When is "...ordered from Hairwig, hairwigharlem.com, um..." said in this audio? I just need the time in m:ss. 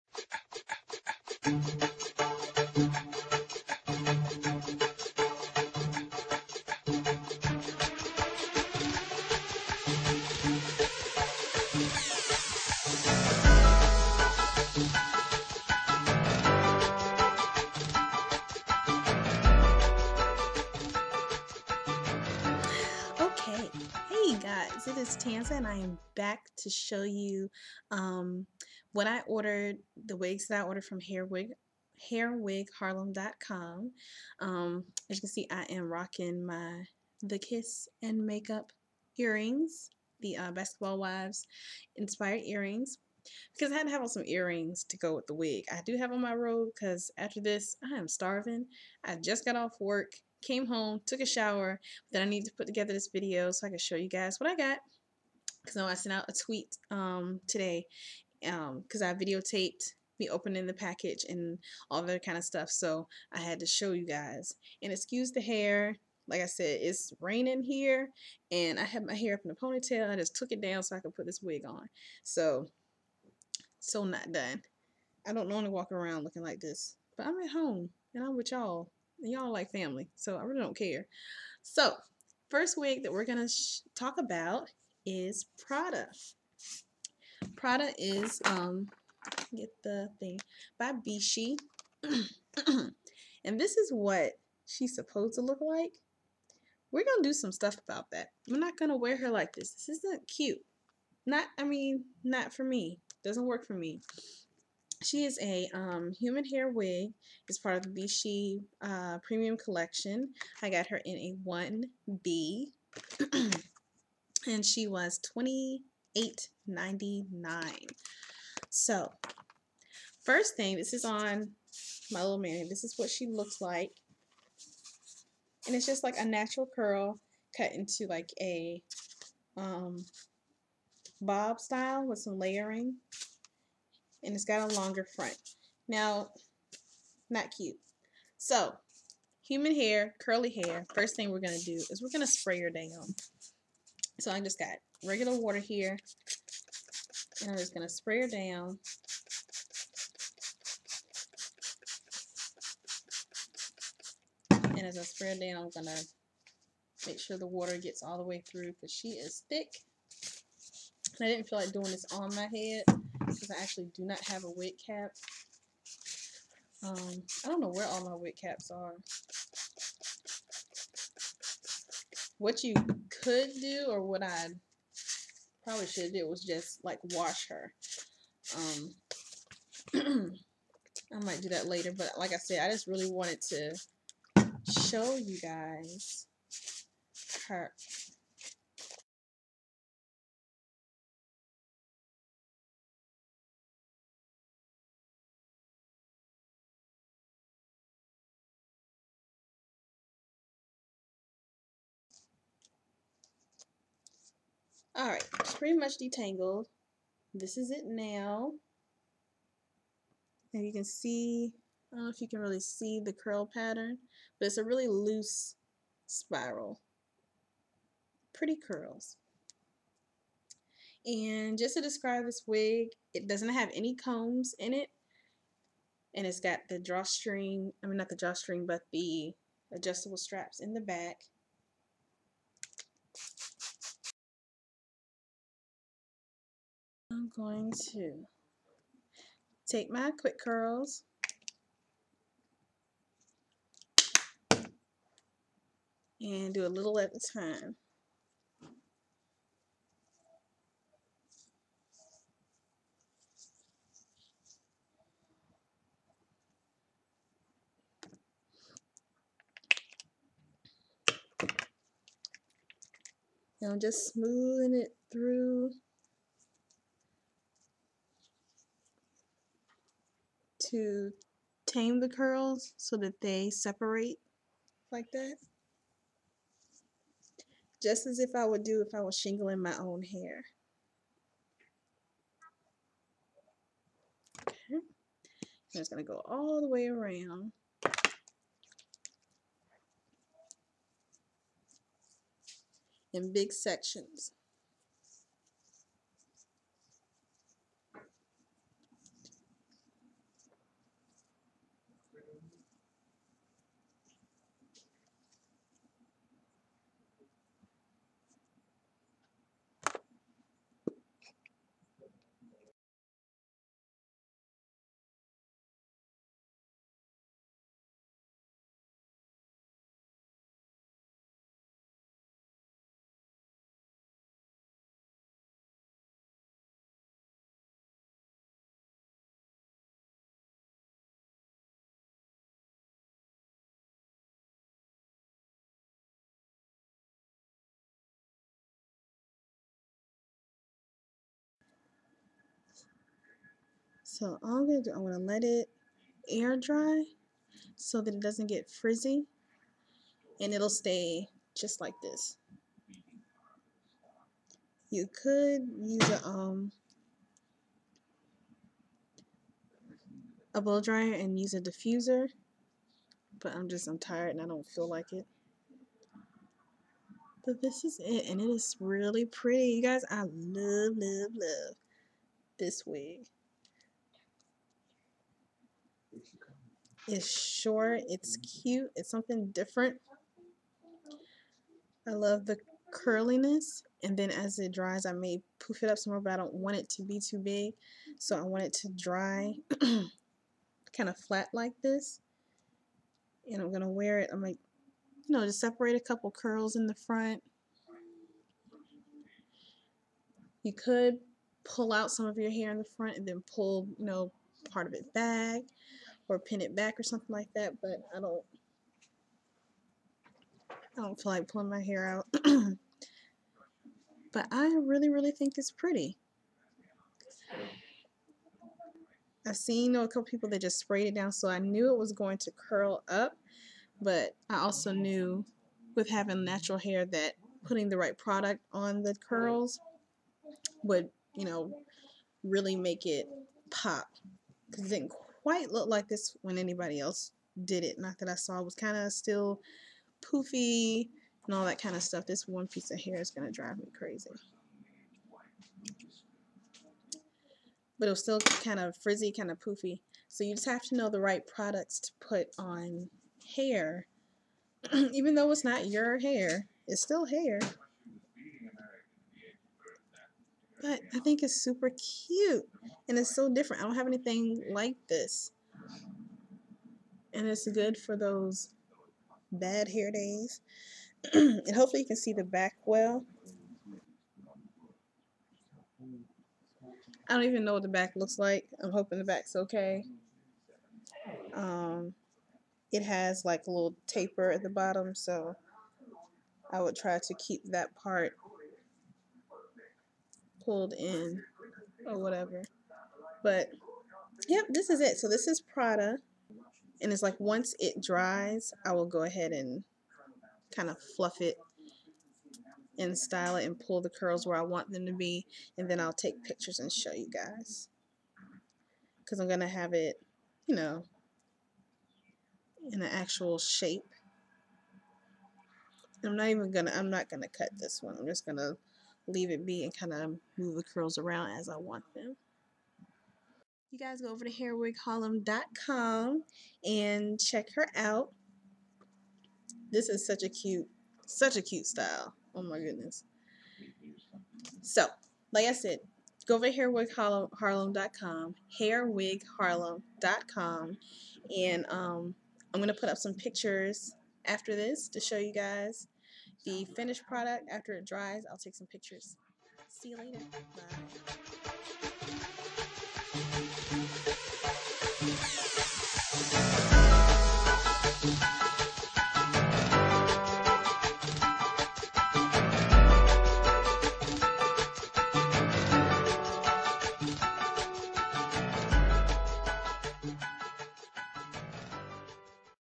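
0:30.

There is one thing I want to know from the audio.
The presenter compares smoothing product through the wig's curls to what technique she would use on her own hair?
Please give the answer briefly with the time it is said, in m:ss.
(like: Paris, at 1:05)
shingling, at 4:39.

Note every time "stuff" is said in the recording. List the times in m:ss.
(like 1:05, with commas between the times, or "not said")
1:02, 1:37, 7:22.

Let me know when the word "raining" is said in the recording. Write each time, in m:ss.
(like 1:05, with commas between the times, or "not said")
1:07.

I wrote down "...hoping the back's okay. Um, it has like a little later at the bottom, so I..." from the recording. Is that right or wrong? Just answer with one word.
wrong.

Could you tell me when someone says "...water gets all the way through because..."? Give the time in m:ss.
2:37.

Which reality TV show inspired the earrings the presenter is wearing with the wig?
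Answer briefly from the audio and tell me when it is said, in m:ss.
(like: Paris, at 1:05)
Basketball Wives, at 0:40.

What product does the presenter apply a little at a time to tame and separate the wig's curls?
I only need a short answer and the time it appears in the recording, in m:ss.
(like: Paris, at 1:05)
quick curls, at 4:00.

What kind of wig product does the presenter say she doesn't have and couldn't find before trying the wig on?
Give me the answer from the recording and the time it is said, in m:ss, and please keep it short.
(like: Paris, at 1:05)
wig cap, at 2:44.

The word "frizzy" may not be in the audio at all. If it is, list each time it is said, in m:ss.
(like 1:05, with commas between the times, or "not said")
5:48, 7:28.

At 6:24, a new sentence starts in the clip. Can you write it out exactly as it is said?
And then as it dries, I may poof it up some more, but I don't want it to be too big.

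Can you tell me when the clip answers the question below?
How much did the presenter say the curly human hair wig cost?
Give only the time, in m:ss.
1:55.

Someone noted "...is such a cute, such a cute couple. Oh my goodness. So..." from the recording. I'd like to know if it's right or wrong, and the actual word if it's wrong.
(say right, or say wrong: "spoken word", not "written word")
wrong: "style", not "couple".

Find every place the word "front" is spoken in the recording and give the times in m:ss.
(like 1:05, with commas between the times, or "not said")
2:15, 6:36, 6:42.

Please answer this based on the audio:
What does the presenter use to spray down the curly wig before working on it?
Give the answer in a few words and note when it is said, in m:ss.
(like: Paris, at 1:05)
regular water, at 2:25.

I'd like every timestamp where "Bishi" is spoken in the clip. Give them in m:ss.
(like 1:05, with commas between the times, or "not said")
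1:30, 1:48.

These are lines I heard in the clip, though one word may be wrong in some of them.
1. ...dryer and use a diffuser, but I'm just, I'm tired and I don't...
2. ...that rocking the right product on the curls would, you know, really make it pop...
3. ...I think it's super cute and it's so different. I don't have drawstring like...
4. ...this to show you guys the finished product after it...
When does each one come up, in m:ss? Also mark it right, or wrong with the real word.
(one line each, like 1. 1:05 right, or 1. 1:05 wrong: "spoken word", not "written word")
1. 6:00 right
2. 7:07 wrong: "putting", not "rocking"
3. 7:41 wrong: "anything", not "drawstring"
4. 9:04 right.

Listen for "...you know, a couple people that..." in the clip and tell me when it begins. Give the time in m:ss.
6:59.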